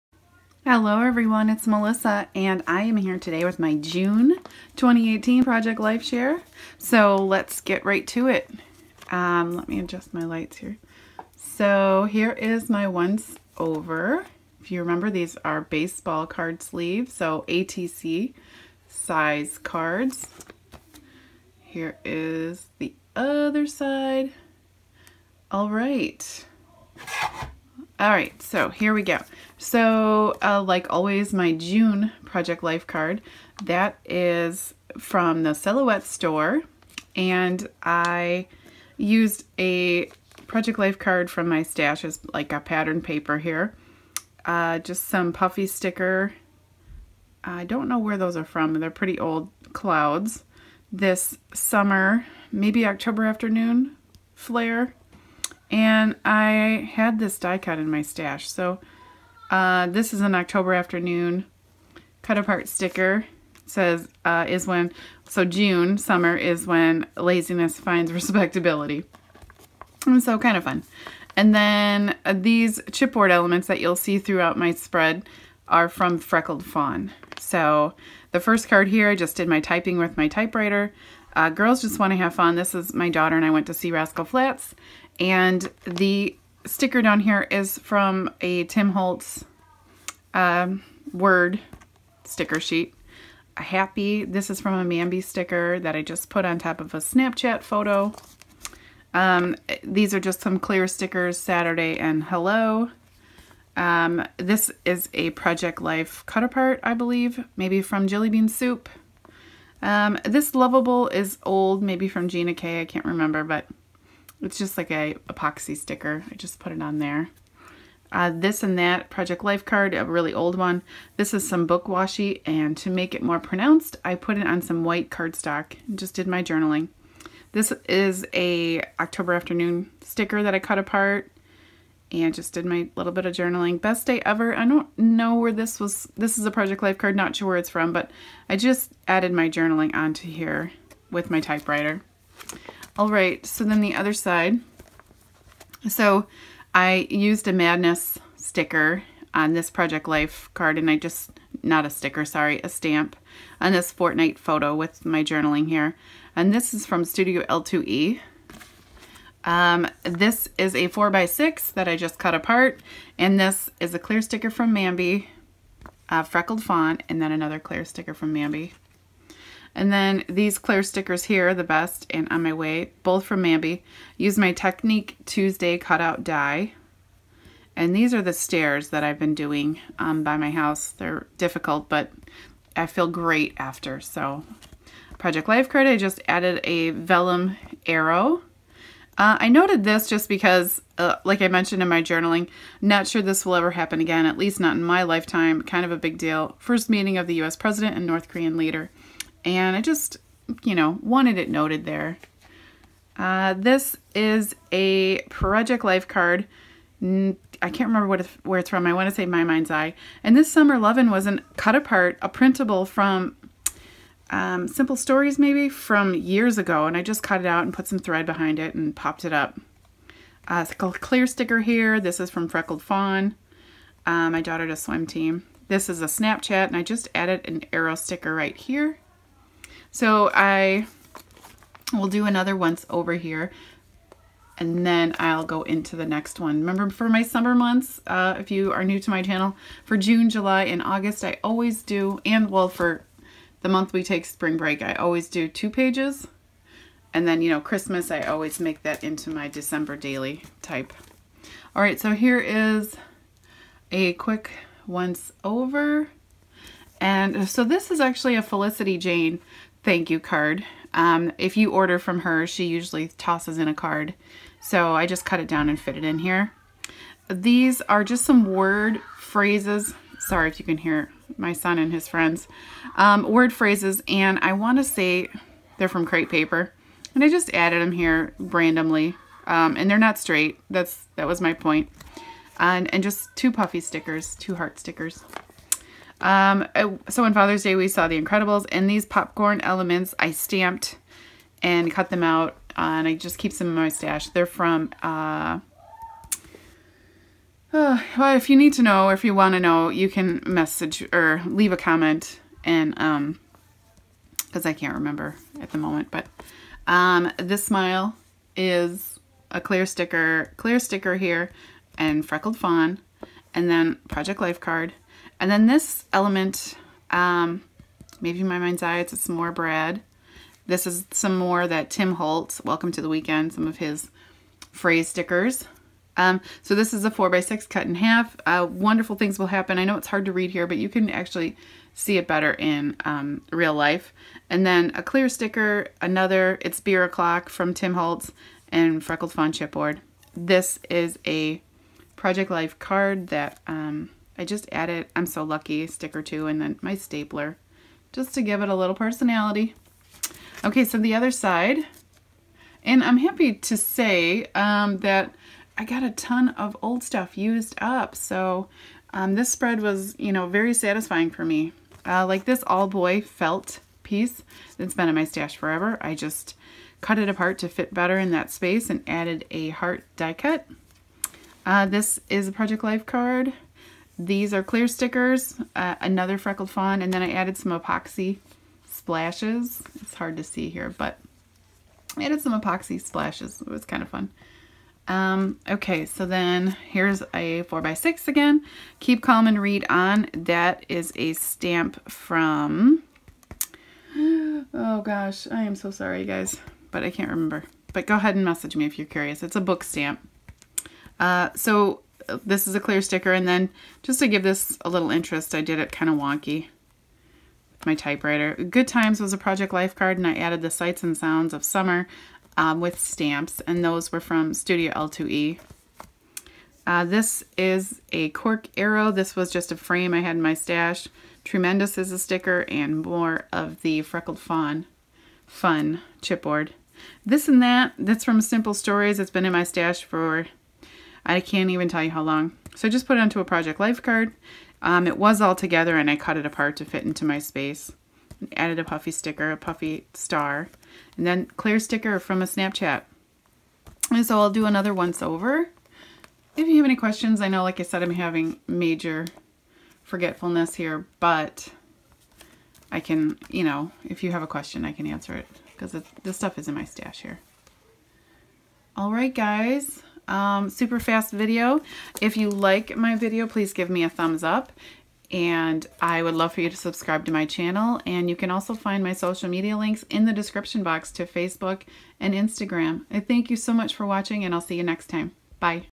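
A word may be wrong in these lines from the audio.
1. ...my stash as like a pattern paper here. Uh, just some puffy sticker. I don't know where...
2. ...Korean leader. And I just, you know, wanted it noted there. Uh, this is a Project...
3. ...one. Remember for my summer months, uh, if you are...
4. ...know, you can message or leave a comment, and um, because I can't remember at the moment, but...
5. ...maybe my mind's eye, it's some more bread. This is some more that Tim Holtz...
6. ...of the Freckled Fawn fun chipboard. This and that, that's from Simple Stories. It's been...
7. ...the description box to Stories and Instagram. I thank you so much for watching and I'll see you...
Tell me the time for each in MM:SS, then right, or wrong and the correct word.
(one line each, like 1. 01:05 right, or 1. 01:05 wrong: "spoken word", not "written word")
1. 00:41 right
2. 03:18 right
3. 03:56 right
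4. 04:59 right
5. 05:18 right
6. 07:03 right
7. 07:50 wrong: "Facebook", not "Stories".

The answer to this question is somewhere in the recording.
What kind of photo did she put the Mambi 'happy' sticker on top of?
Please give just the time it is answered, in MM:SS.
01:36.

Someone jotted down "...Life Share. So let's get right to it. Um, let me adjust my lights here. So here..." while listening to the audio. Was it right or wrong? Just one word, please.
right.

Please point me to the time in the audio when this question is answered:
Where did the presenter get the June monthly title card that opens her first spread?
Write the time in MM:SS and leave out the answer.
00:35.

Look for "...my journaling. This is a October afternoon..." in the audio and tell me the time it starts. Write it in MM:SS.
02:06.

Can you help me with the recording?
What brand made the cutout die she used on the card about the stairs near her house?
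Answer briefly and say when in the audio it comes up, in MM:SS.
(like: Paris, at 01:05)
Technique Tuesday, at 02:54.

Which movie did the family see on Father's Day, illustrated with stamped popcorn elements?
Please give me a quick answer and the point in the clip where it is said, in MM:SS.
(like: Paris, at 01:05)
The Incredibles, at 04:48.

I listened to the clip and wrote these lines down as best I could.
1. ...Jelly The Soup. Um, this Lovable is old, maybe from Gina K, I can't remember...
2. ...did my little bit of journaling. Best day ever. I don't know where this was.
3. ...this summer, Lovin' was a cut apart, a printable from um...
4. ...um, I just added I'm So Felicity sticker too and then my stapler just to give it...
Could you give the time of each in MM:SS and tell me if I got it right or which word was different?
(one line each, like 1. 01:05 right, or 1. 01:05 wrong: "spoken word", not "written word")
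1. 01:48 wrong: "Bean", not "The"
2. 02:12 right
3. 03:30 right
4. 05:43 wrong: "Lucky", not "Felicity".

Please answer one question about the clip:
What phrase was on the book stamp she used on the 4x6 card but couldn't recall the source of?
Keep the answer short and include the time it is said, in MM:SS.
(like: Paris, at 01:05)
Keep Calm and Read On, at 06:28.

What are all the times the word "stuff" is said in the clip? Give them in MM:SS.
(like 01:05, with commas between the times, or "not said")
05:57, 07:36.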